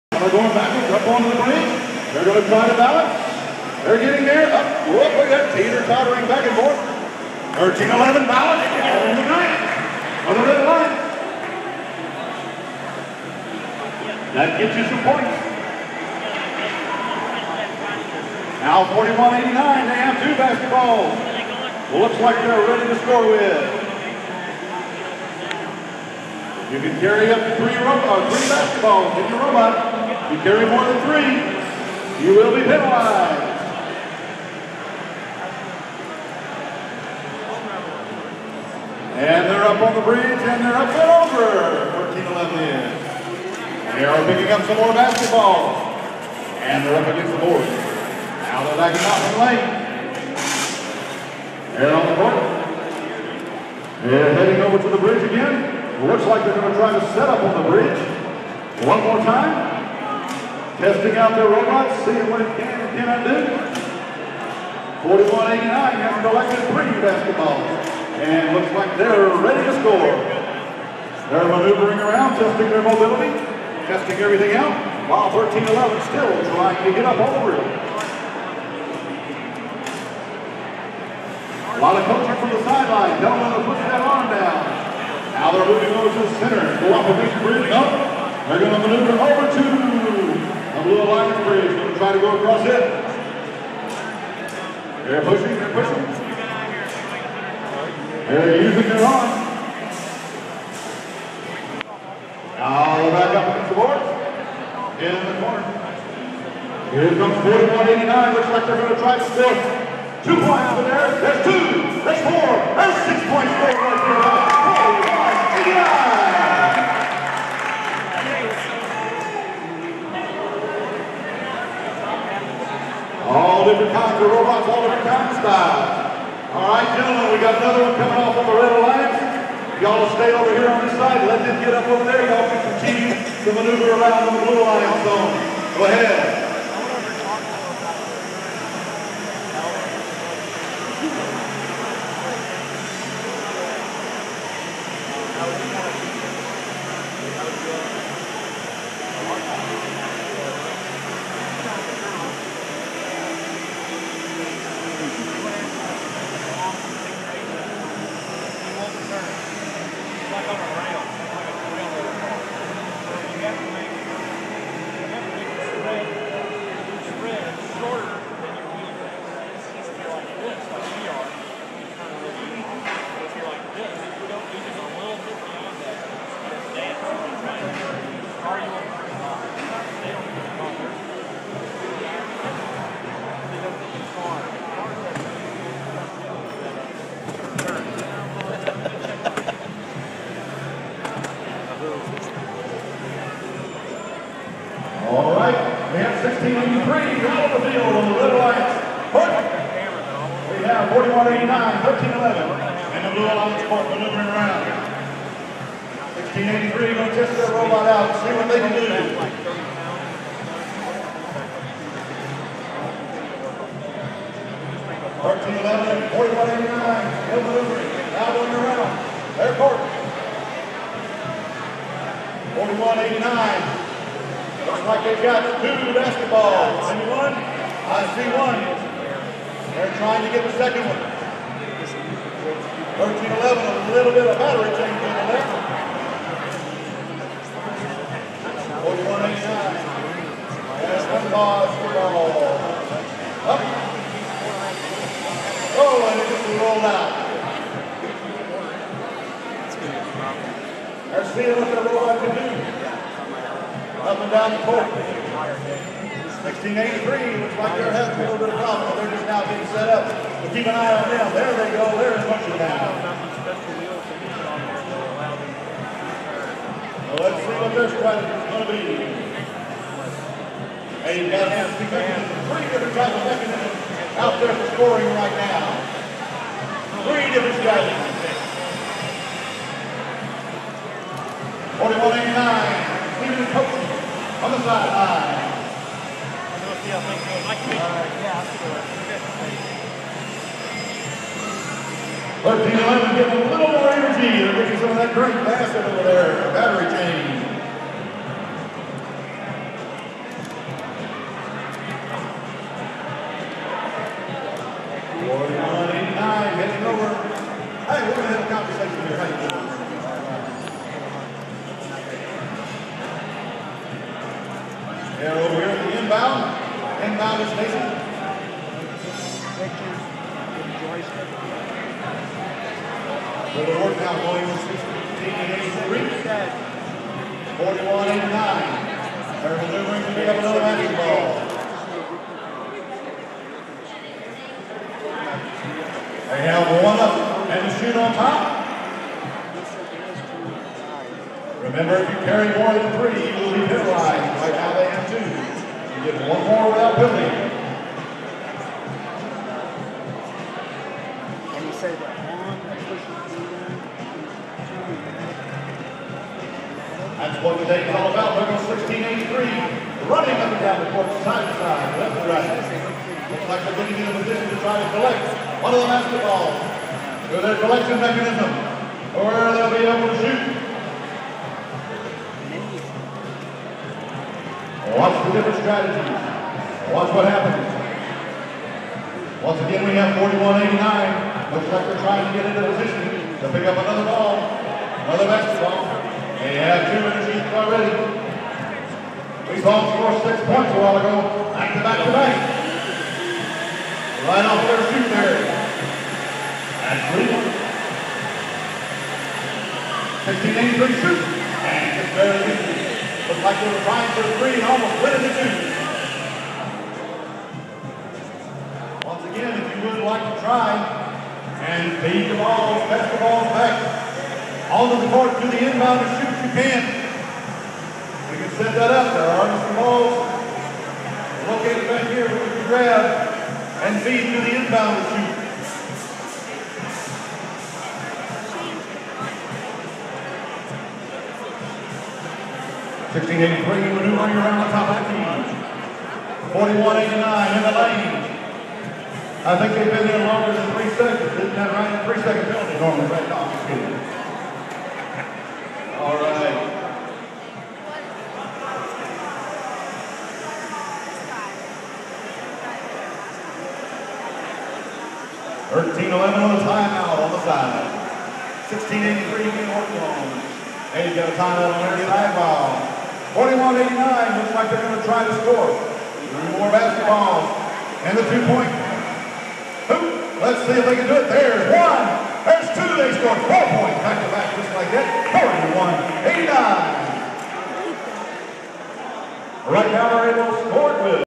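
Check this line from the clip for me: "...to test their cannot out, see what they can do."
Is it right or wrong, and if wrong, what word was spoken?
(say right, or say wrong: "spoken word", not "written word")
wrong: "robot", not "cannot".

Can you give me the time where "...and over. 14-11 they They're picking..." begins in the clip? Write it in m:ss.
0:40.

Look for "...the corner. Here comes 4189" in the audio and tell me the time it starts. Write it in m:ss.
1:45.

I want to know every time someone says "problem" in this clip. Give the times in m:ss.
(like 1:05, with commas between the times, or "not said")
4:18.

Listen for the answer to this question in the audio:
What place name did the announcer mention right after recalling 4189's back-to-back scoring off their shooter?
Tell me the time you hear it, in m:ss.
6:36.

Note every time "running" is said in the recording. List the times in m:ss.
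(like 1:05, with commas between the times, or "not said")
6:00.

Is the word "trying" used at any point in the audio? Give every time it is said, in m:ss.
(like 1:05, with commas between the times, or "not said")
1:16, 3:49, 6:22, 6:43.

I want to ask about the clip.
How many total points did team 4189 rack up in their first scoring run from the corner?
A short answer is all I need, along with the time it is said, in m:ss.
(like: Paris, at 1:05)
6, at 1:52.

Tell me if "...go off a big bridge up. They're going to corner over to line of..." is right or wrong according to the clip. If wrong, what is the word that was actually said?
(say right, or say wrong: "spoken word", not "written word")
wrong: "maneuver", not "corner".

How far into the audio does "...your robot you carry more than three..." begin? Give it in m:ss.
0:29.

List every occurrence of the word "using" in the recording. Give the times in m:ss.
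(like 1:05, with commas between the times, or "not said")
1:38.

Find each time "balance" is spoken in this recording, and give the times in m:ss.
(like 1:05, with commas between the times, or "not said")
0:02, 0:08.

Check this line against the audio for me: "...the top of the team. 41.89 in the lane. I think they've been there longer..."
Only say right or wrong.
right.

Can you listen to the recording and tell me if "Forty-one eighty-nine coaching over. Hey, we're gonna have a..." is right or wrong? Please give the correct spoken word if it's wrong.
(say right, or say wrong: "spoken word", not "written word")
wrong: "heading", not "coaching".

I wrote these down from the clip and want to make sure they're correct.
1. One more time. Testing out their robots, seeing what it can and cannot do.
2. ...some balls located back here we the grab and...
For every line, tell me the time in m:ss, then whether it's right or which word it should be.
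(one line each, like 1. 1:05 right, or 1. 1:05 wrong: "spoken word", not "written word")
1. 0:58 right
2. 6:59 right.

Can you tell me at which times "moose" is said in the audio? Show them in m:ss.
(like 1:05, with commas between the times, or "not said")
not said.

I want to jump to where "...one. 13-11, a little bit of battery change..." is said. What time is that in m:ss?
3:50.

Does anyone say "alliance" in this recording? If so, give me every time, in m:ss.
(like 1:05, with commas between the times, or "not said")
3:18, 3:23.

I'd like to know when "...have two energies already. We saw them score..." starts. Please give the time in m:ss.
6:26.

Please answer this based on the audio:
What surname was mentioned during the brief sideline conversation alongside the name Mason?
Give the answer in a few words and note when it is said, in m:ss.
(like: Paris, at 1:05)
Williams, at 5:24.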